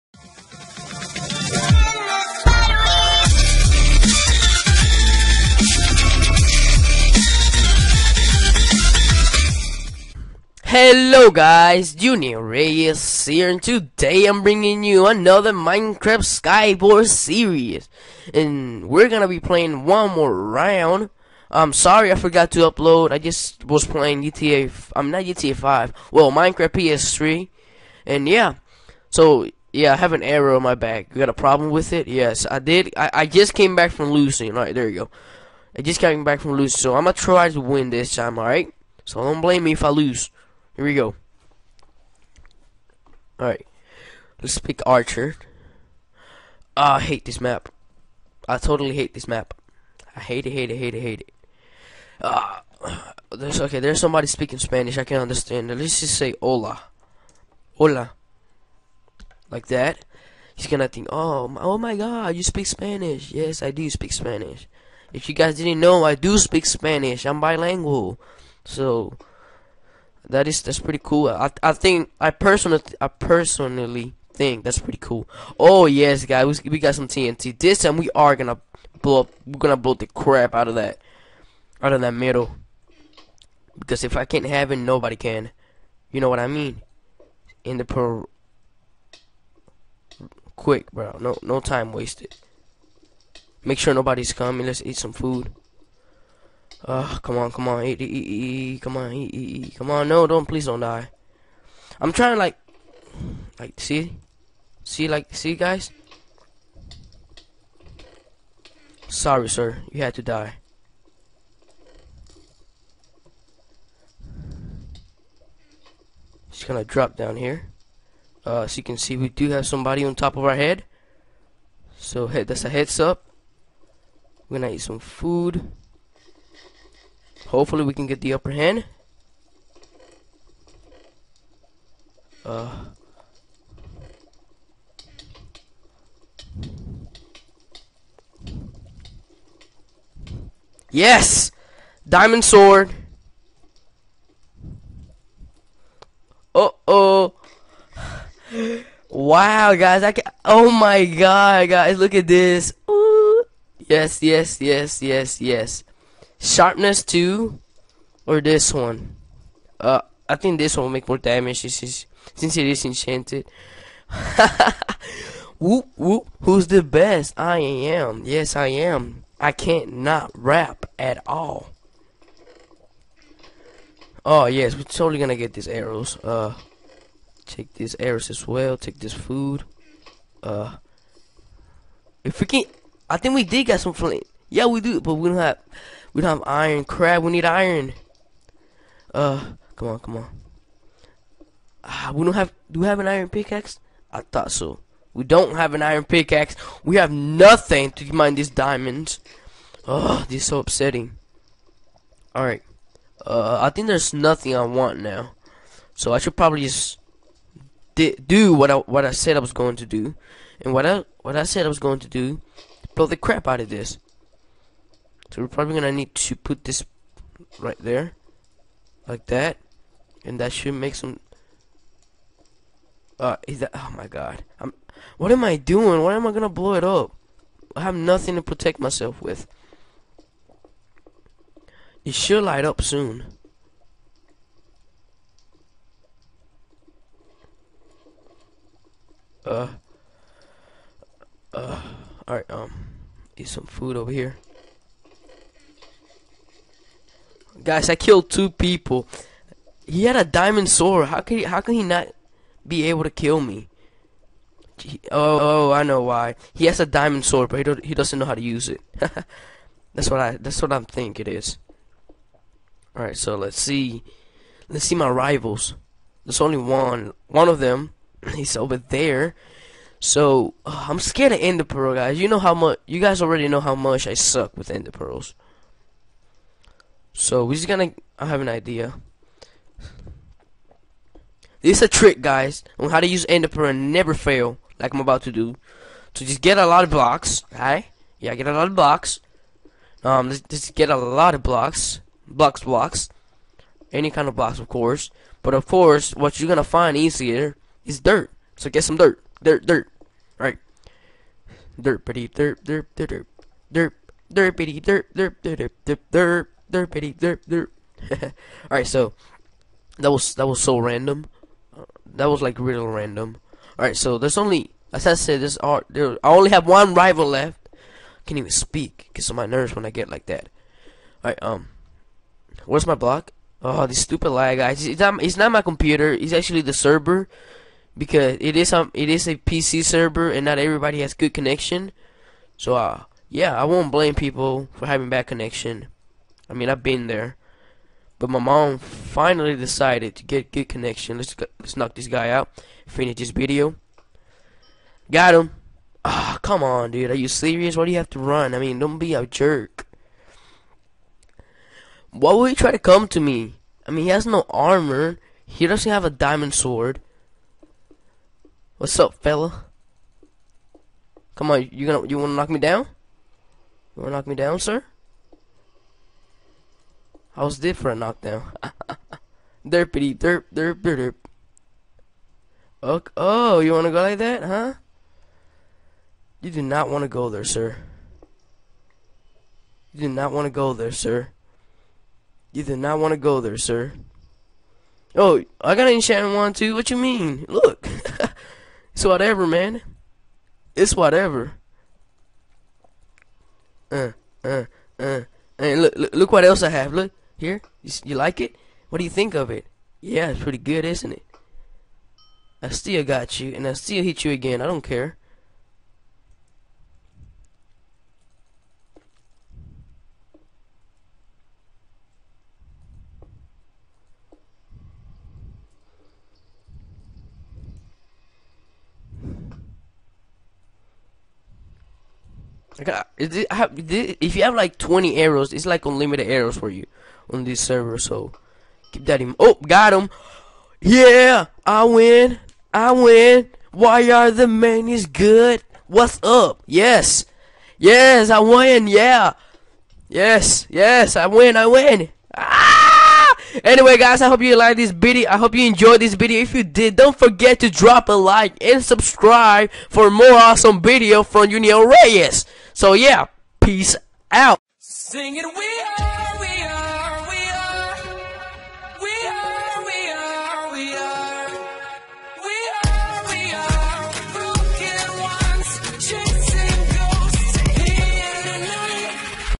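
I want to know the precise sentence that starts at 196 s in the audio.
We have nothing to mine these diamonds.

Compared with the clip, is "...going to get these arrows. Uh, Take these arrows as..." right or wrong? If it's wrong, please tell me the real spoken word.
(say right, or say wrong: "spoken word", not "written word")
right.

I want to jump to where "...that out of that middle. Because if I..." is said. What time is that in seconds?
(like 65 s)
80 s.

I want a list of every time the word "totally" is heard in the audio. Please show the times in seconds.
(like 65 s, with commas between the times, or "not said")
48 s, 174 s.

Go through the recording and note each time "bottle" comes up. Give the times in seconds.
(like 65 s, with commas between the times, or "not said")
not said.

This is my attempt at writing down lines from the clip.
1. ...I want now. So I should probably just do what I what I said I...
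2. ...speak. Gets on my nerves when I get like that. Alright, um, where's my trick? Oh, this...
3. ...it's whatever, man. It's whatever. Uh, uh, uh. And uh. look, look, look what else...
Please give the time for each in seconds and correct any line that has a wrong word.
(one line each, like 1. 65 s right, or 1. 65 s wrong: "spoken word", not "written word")
1. 204 s right
2. 318 s wrong: "block", not "trick"
3. 388 s right.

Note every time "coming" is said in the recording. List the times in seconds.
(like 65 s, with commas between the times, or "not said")
94 s.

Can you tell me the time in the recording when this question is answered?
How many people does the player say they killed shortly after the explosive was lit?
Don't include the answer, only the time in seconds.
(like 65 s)
248 s.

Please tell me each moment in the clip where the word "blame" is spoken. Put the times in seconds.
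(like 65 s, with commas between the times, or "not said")
39 s, 333 s.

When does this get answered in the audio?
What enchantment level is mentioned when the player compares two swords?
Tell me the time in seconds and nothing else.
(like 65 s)
156 s.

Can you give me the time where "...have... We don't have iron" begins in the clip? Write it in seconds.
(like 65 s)
185 s.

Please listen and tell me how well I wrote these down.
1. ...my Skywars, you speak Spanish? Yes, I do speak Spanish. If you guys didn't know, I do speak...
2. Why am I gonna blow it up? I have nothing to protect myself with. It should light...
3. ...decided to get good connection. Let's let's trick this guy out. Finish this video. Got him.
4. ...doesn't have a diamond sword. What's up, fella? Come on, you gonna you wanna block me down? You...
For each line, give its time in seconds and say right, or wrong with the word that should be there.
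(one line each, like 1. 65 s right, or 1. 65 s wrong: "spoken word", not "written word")
1. 61 s wrong: "God", not "Skywars"
2. 226 s right
3. 339 s wrong: "knock", not "trick"
4. 355 s wrong: "knock", not "block".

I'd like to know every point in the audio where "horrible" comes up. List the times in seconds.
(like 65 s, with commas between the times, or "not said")
not said.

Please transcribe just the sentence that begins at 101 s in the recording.
I'm trying to, like, like, see?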